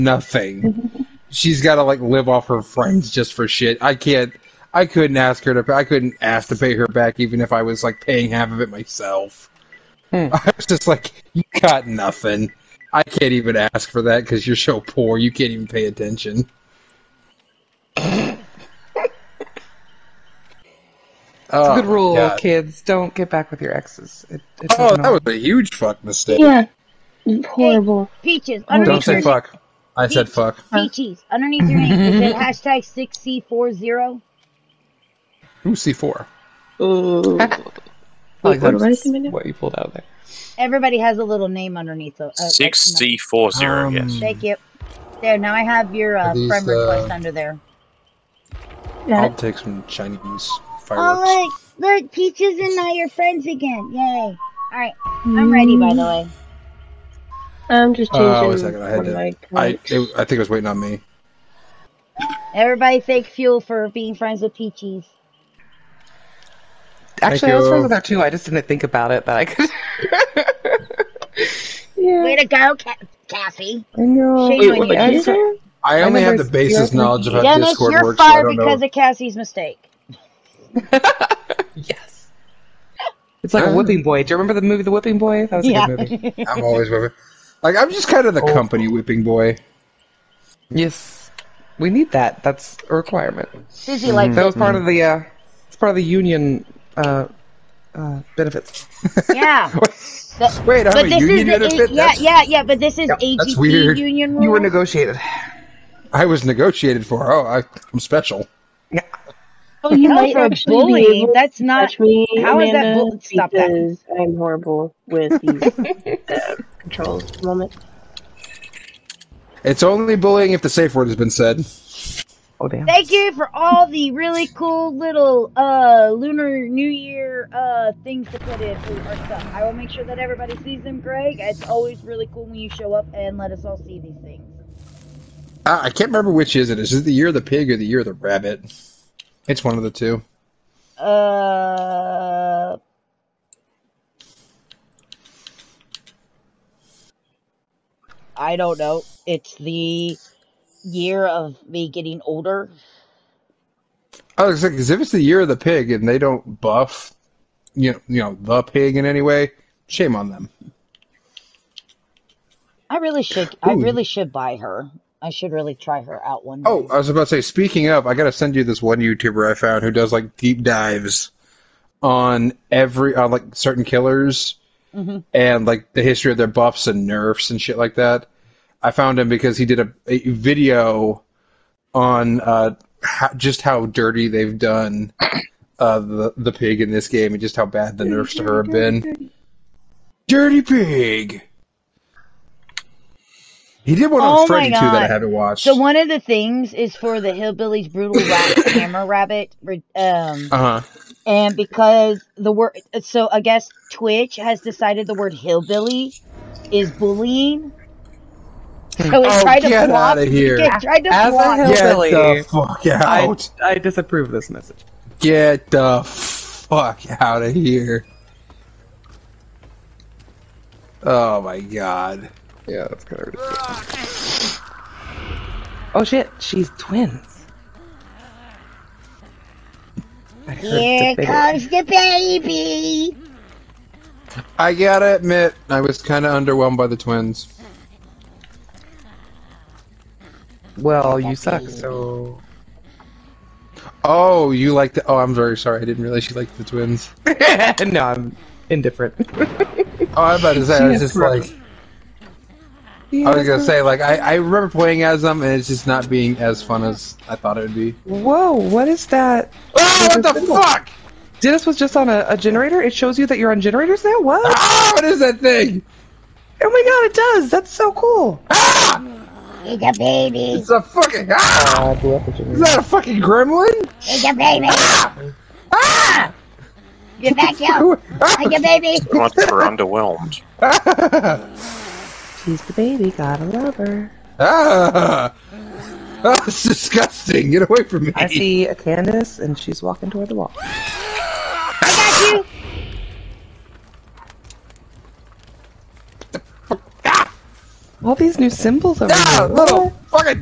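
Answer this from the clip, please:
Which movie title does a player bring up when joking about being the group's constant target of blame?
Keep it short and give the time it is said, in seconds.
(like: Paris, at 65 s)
The Whipping Boy, at 84 s.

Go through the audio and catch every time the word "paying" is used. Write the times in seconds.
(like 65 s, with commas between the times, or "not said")
8 s.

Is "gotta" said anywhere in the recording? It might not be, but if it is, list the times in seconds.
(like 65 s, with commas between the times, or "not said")
234 s, 283 s.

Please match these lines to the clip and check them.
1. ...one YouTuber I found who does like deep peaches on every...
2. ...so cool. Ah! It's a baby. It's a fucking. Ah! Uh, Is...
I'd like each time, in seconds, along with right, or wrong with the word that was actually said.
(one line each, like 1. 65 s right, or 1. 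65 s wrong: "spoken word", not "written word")
1. 168 s wrong: "dives", not "peaches"
2. 267 s right.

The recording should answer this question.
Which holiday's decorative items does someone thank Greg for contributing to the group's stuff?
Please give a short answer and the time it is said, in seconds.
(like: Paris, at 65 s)
Lunar New Year, at 126 s.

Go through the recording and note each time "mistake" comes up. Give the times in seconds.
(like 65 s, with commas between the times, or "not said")
26 s, 79 s.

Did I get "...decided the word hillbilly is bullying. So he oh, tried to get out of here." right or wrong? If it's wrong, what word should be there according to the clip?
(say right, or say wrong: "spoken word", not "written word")
right.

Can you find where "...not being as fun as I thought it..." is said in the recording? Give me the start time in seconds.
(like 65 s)
255 s.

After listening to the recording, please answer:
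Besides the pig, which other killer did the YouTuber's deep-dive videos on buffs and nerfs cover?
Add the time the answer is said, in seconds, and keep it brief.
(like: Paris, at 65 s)
Freddy, at 194 s.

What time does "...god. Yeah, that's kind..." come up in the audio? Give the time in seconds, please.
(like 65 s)
221 s.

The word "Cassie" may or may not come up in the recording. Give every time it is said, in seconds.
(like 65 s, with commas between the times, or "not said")
73 s, 78 s.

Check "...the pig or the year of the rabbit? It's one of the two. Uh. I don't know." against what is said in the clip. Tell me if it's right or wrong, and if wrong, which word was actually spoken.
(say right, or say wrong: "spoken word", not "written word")
right.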